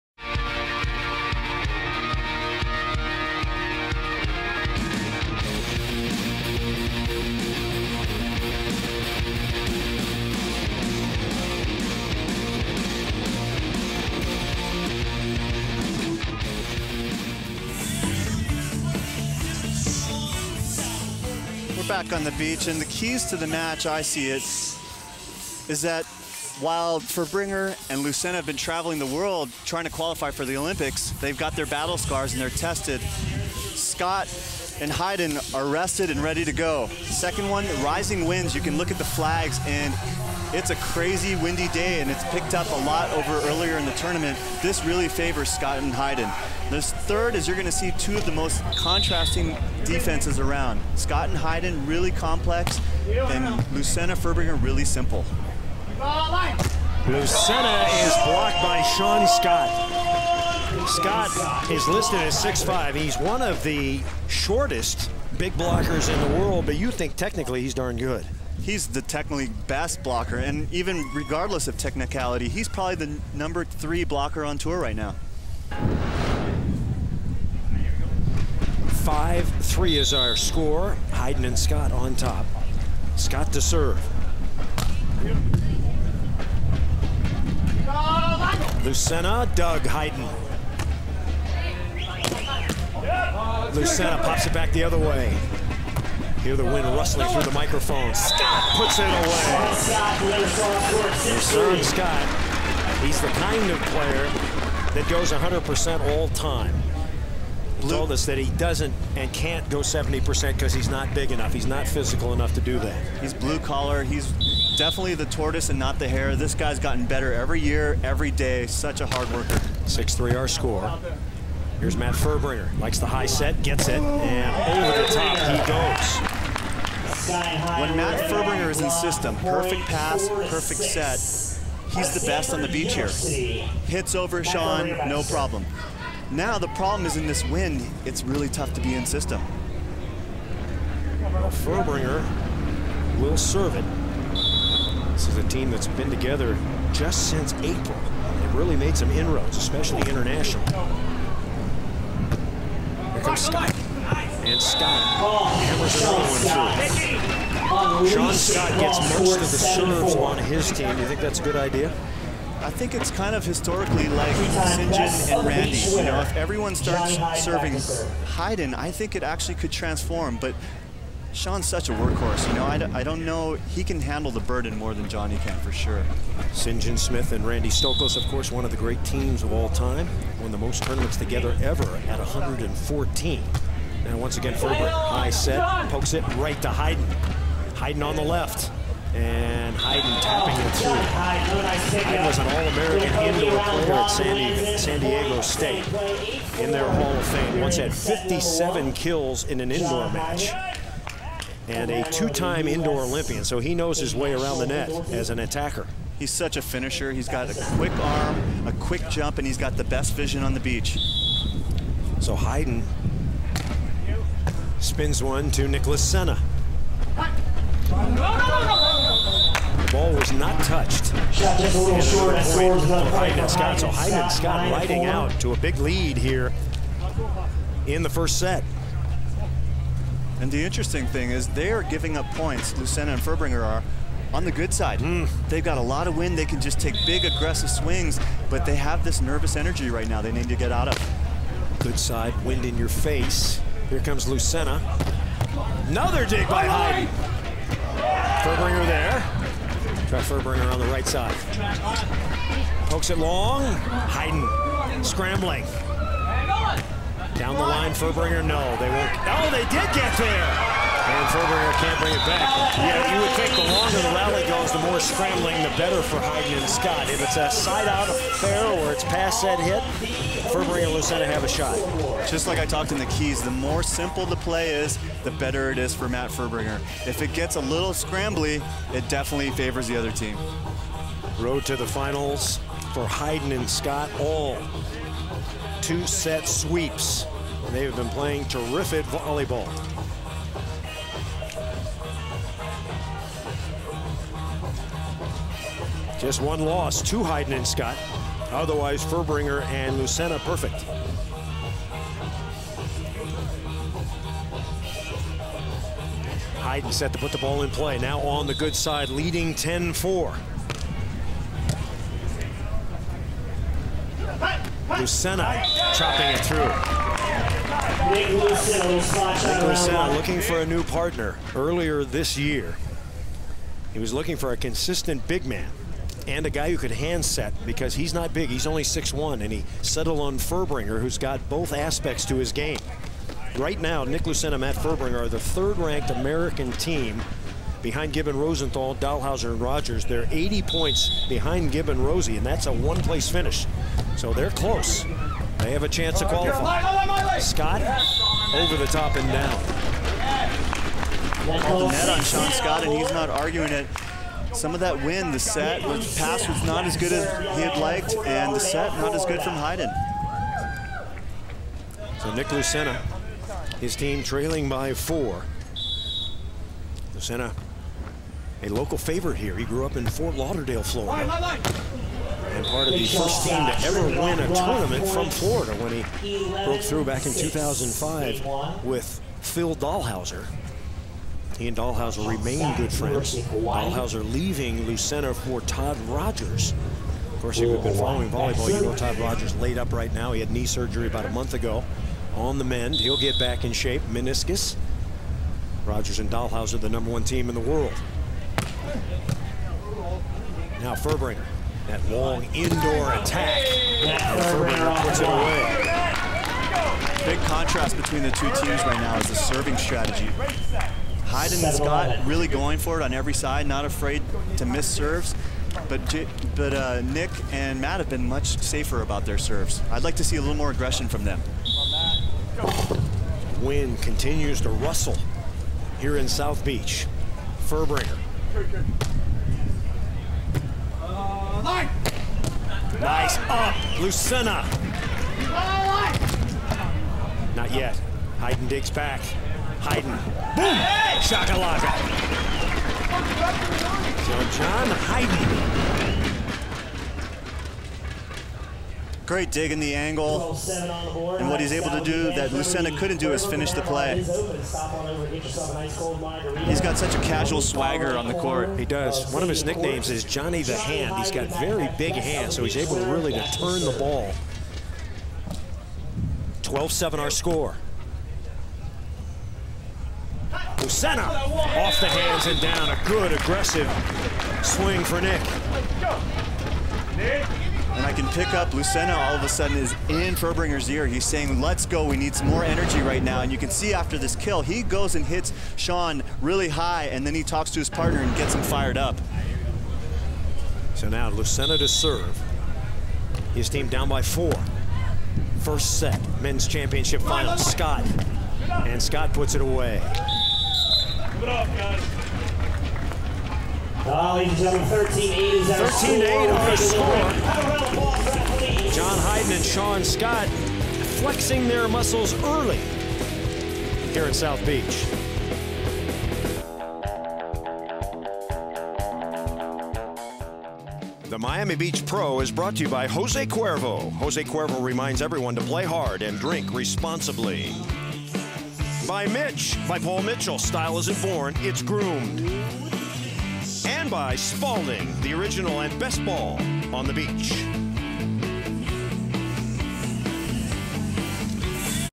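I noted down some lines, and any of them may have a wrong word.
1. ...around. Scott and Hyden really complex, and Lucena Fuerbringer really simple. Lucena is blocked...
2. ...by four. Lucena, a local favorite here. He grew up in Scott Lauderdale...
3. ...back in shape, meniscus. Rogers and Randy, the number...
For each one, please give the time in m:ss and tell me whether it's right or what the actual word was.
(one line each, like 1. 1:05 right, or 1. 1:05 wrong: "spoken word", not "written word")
1. 0:50 right
2. 6:04 wrong: "Fort", not "Scott"
3. 6:33 wrong: "Dalhausser", not "Randy".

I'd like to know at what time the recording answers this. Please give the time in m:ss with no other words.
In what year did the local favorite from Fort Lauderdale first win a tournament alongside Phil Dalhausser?
6:17.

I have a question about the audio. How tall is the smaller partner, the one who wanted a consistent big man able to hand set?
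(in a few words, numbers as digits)
6'1".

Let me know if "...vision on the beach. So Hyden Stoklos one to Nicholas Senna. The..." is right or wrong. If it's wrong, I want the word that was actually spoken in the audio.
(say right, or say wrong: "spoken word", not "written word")
wrong: "Spins", not "Stoklos".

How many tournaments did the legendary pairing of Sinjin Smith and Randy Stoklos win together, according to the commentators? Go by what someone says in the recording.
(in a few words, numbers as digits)
114.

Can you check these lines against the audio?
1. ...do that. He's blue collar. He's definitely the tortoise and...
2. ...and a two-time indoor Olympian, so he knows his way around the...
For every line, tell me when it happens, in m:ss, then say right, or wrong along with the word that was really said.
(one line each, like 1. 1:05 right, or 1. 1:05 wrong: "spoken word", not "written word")
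1. 1:52 right
2. 3:21 right.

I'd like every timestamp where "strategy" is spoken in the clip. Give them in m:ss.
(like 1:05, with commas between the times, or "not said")
6:49.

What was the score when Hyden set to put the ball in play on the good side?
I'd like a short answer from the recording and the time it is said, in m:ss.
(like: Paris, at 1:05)
10-4, at 5:09.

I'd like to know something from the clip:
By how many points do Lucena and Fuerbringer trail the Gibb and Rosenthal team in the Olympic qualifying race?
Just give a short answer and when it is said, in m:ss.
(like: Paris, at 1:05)
80, at 5:40.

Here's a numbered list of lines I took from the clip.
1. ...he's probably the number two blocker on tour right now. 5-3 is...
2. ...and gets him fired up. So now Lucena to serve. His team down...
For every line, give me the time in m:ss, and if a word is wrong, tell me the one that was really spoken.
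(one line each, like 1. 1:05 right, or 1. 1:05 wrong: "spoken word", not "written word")
1. 1:12 wrong: "three", not "two"
2. 8:08 right.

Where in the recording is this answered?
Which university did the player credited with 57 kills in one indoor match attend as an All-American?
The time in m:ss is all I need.
3:14.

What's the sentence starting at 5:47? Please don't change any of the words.
Scott over the top and down.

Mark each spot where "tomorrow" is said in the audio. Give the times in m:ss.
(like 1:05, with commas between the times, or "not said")
not said.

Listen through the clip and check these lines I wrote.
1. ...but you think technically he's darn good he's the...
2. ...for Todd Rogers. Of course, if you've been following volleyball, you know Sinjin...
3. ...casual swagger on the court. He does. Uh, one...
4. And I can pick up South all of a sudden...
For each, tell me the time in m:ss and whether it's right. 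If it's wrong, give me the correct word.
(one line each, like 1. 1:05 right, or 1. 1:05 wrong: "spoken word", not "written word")
1. 1:06 right
2. 6:25 wrong: "Todd", not "Sinjin"
3. 7:37 right
4. 7:58 wrong: "Lucena", not "South".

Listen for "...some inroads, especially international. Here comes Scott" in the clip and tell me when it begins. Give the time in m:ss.
2:28.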